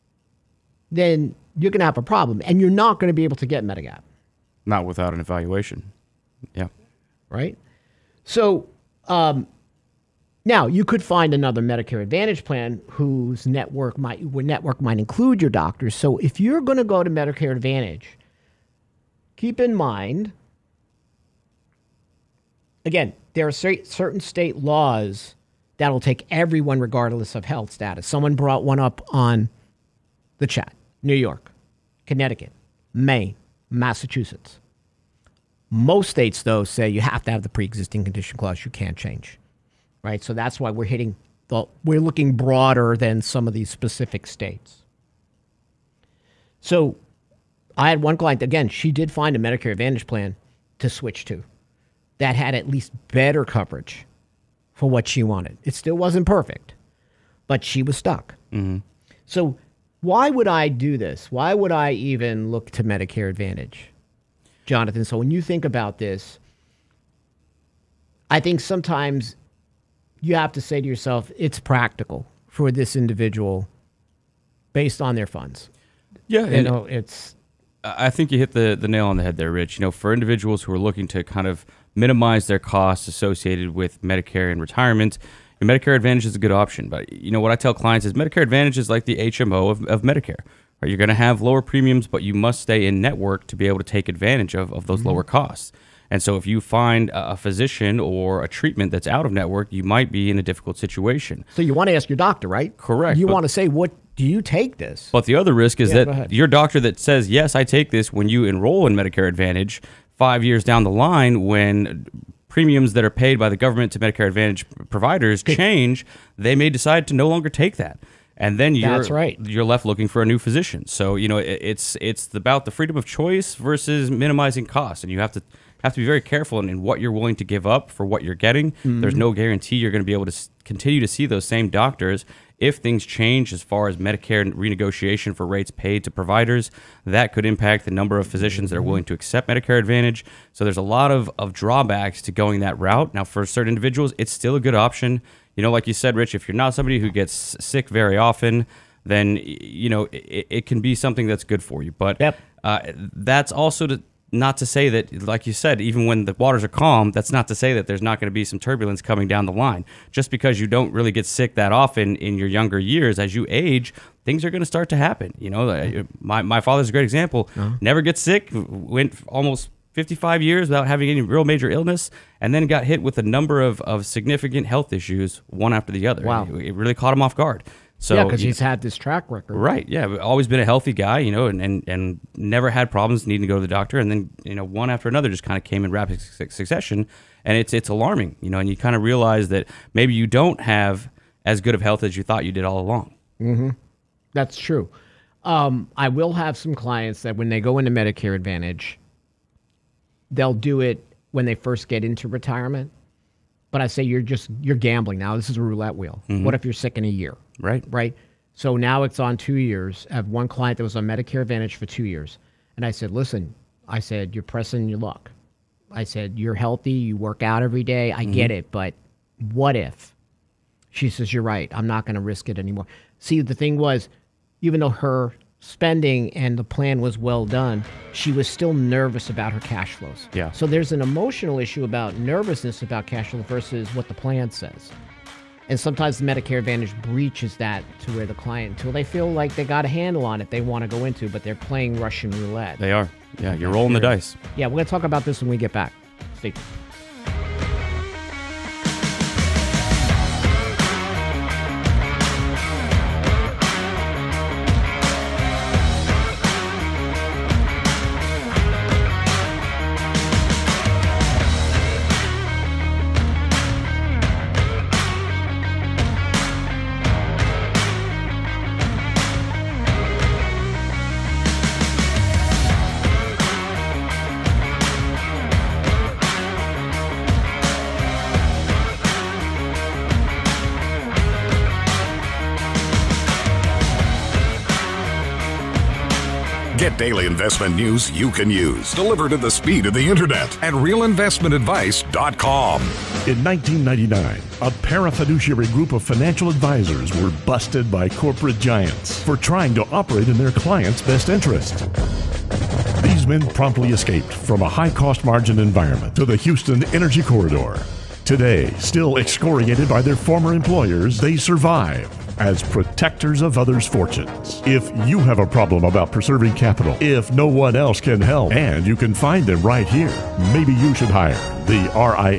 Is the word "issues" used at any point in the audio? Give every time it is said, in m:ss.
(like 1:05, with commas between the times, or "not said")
2:54, 3:51.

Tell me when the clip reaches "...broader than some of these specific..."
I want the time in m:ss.
0:42.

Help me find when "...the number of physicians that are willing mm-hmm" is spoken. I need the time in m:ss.
2:17.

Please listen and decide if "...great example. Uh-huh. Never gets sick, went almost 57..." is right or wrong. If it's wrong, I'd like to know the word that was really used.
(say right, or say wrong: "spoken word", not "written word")
wrong: "55", not "57".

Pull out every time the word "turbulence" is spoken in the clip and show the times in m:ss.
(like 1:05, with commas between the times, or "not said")
2:38.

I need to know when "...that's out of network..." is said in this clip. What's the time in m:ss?
1:38.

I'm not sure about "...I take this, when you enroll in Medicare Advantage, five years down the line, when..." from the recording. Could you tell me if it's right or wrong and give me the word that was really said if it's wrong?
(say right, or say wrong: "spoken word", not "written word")
right.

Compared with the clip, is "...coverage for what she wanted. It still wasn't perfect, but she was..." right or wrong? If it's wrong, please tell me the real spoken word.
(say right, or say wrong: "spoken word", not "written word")
right.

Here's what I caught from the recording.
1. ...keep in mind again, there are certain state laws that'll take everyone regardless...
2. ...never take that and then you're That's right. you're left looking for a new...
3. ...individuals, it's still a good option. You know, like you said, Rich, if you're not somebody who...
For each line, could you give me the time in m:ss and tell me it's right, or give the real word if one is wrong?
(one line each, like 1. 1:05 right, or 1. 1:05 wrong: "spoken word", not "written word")
1. 0:19 right
2. 1:57 wrong: "longer", not "never"
3. 2:23 right.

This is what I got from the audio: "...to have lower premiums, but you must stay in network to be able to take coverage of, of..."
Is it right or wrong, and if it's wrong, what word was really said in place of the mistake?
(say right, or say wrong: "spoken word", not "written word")
wrong: "advantage", not "coverage".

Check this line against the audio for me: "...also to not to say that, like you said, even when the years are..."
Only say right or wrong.
wrong.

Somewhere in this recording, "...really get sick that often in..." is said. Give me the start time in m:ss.
2:40.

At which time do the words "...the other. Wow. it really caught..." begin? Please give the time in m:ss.
2:55.